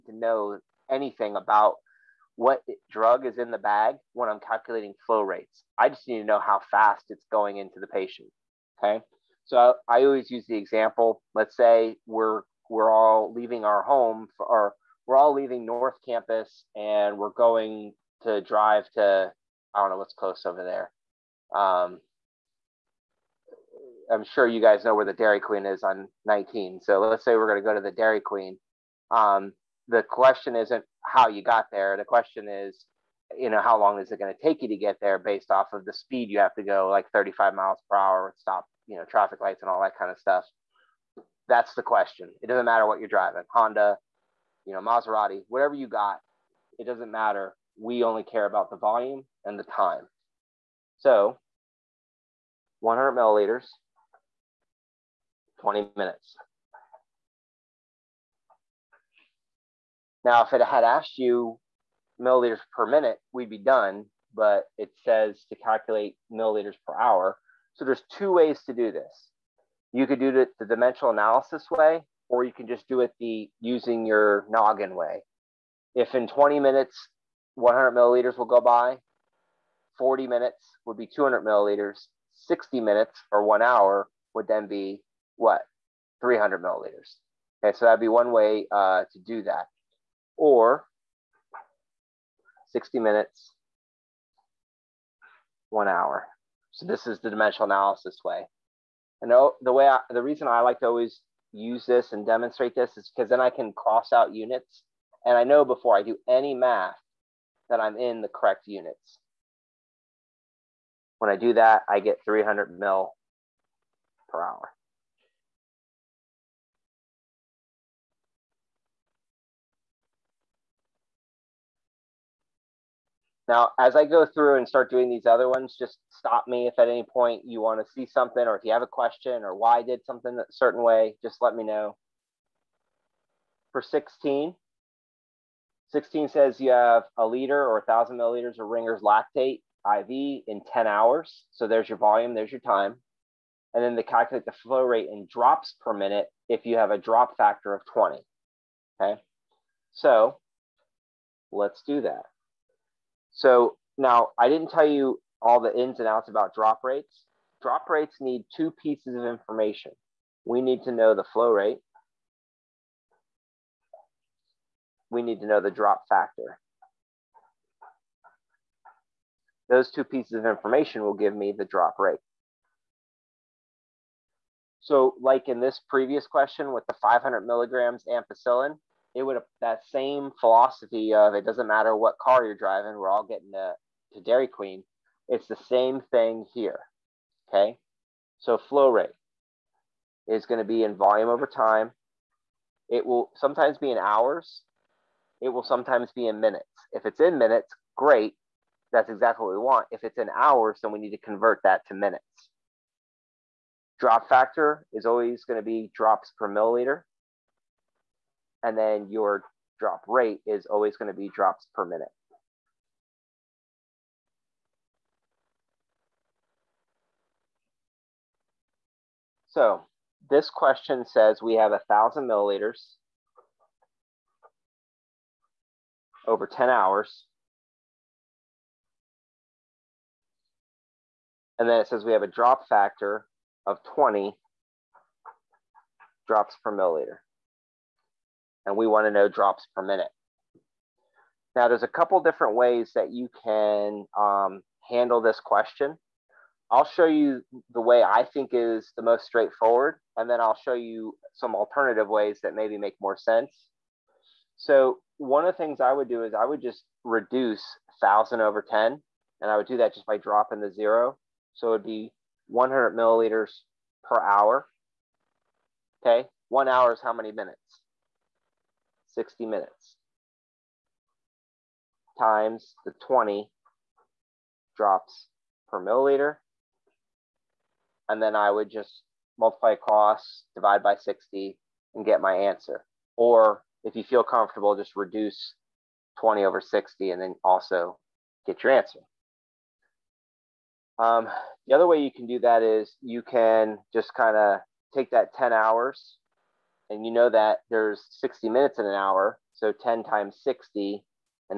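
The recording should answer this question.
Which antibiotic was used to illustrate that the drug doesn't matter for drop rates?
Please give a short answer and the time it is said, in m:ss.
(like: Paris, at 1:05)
ampicillin, at 2:58.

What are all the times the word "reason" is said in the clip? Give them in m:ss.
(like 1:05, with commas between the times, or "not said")
1:40.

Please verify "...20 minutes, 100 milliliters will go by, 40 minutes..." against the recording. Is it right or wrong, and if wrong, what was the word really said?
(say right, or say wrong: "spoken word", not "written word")
right.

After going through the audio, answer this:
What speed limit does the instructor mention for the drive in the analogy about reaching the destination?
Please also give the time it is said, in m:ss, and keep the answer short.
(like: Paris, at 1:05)
35 miles per hour, at 0:37.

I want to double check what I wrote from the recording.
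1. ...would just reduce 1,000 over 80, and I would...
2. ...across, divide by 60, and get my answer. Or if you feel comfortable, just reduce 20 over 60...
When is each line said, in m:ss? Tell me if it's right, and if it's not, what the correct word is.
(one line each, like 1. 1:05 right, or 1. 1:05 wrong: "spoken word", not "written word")
1. 4:16 wrong: "10", not "80"
2. 4:39 right.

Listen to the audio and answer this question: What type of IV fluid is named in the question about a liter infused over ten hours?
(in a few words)
Ringer's lactate.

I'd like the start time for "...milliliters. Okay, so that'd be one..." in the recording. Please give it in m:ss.
1:26.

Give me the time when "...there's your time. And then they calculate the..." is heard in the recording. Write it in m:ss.
2:22.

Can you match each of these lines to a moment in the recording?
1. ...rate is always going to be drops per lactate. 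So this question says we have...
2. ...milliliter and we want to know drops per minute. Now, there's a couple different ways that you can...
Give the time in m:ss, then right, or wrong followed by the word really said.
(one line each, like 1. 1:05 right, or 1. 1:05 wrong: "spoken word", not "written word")
1. 3:30 wrong: "minute", not "lactate"
2. 3:56 right.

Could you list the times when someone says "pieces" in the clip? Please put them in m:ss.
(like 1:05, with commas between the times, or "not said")
2:38, 2:50.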